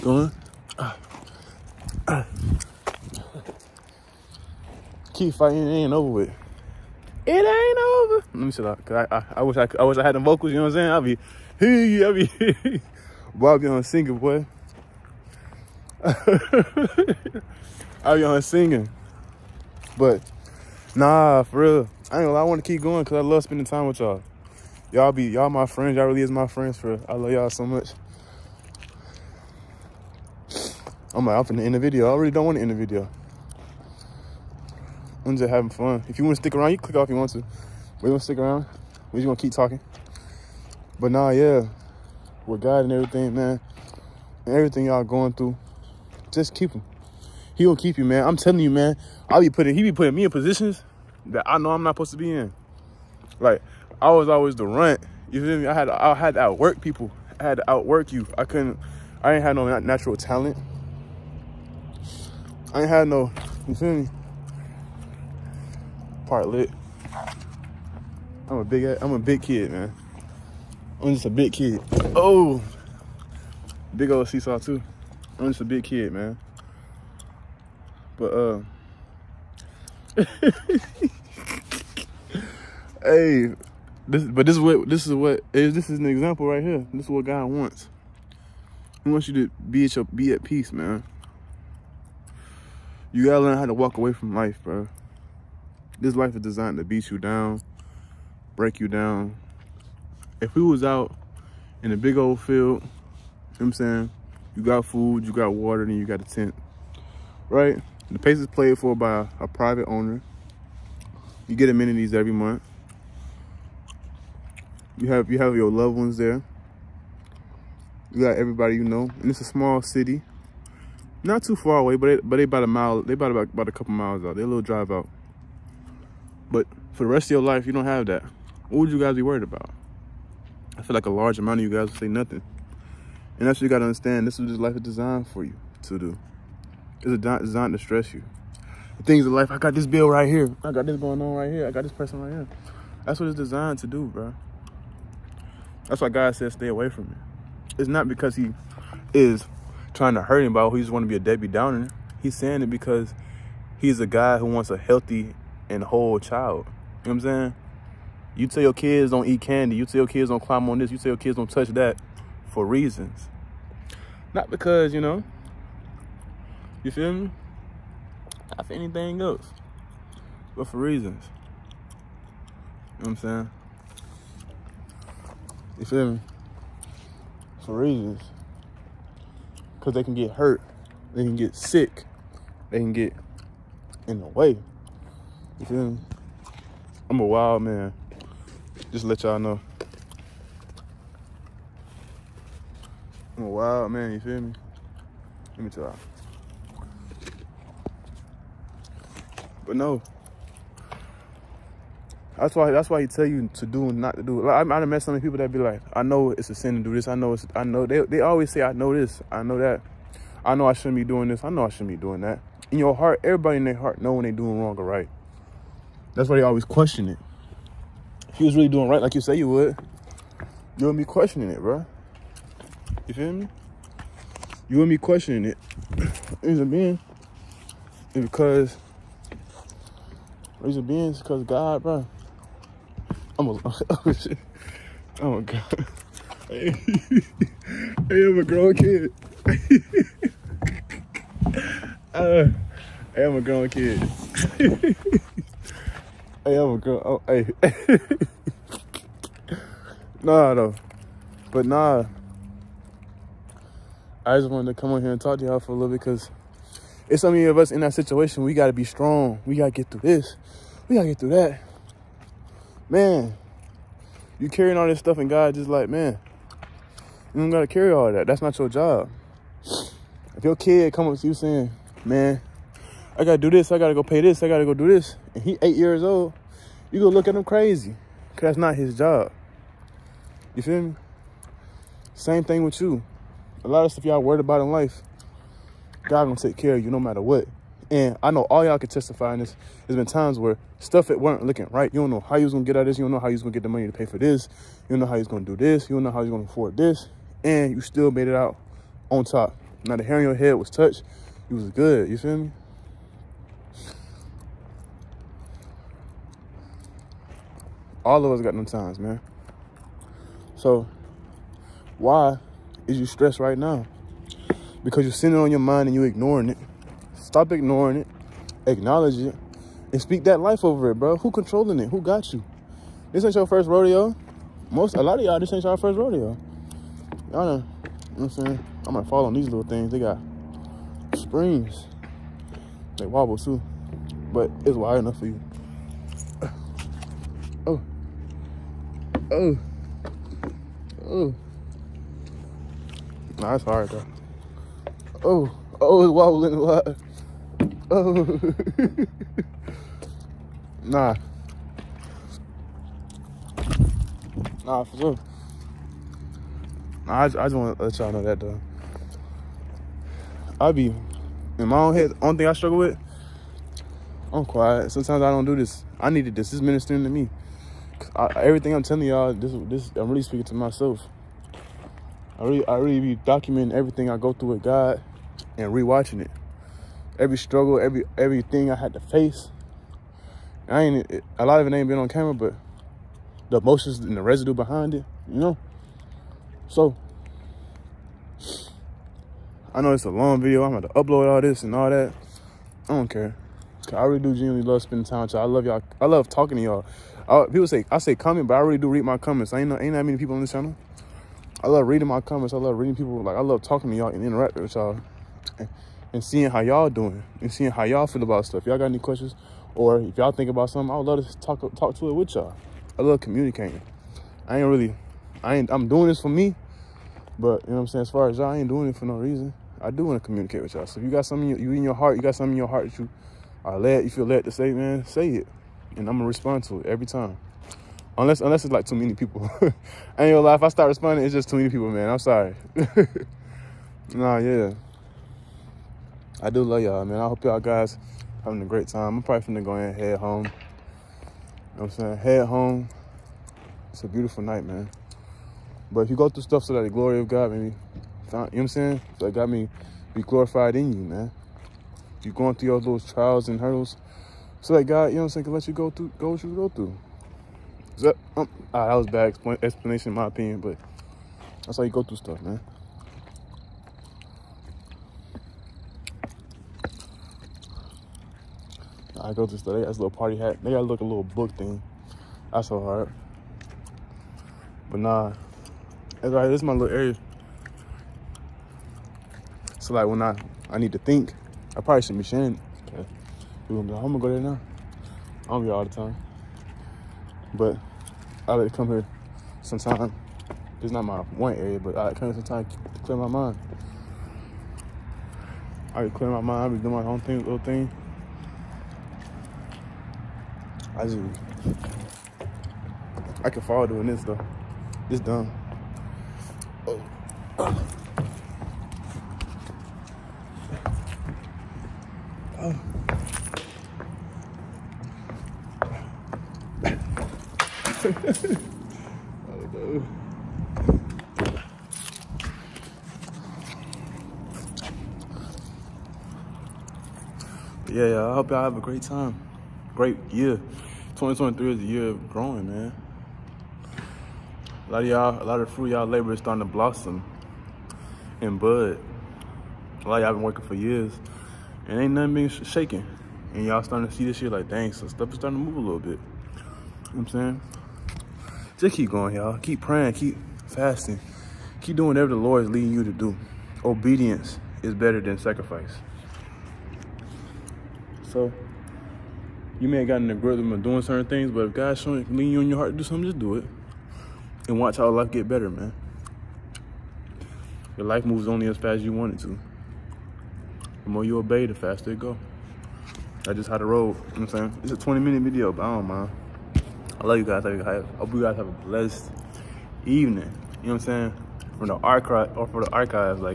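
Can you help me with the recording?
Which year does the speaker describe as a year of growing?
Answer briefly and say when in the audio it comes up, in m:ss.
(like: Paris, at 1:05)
2023, at 8:51.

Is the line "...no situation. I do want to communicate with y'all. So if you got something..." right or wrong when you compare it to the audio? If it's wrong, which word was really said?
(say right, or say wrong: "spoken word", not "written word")
wrong: "reason", not "situation".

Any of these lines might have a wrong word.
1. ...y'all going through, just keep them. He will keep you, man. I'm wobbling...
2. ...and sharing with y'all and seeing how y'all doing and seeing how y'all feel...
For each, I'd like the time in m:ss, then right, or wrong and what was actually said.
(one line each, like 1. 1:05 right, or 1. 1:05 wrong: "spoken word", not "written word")
1. 0:44 wrong: "telling", not "wobbling"
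2. 6:44 wrong: "interacting", not "sharing".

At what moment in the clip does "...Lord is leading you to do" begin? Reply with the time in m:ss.
9:12.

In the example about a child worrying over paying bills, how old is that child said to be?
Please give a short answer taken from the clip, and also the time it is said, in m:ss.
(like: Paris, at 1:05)
8, at 4:35.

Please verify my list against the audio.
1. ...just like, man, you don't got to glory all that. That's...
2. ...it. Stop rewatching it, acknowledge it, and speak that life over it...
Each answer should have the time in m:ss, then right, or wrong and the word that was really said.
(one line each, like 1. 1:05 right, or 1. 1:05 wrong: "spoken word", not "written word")
1. 4:25 wrong: "carry", not "glory"
2. 5:16 wrong: "ignoring", not "rewatching".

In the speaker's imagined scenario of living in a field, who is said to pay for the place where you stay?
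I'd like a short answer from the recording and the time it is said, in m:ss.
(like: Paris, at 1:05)
A private owner, at 1:49.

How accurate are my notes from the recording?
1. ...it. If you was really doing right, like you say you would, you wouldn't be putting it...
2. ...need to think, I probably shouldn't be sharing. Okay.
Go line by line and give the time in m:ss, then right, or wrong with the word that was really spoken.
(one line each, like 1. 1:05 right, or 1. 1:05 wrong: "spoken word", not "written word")
1. 3:37 wrong: "questioning", not "putting"
2. 8:00 right.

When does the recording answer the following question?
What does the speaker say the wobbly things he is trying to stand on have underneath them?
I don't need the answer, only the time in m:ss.
5:31.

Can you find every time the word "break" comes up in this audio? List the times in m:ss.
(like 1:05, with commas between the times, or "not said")
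1:38.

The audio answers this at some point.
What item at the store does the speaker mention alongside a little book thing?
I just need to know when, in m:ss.
7:50.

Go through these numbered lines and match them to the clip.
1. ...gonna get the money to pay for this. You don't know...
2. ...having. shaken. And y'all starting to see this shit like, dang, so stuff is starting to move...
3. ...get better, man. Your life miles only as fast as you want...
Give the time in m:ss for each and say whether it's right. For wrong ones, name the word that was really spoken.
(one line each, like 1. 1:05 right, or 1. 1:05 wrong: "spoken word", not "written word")
1. 4:53 right
2. 9:02 wrong: "shaking", not "having"
3. 9:25 wrong: "moves", not "miles".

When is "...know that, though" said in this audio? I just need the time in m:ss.
5:58.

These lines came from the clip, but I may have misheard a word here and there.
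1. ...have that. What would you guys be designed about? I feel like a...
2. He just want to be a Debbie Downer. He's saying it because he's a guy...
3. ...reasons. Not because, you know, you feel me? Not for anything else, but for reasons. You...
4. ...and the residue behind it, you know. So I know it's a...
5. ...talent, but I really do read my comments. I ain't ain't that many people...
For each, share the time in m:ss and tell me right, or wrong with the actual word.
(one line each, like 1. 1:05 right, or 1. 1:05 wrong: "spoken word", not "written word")
1. 2:07 wrong: "worried", not "designed"
2. 2:30 right
3. 2:42 right
4. 6:23 right
5. 6:38 wrong: "comment", not "talent".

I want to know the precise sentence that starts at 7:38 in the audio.
That, um, ah, that was bad explanation in my opinion, but that's how you go through stuff, man.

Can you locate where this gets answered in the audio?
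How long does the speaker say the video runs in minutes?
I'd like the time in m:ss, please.
9:34.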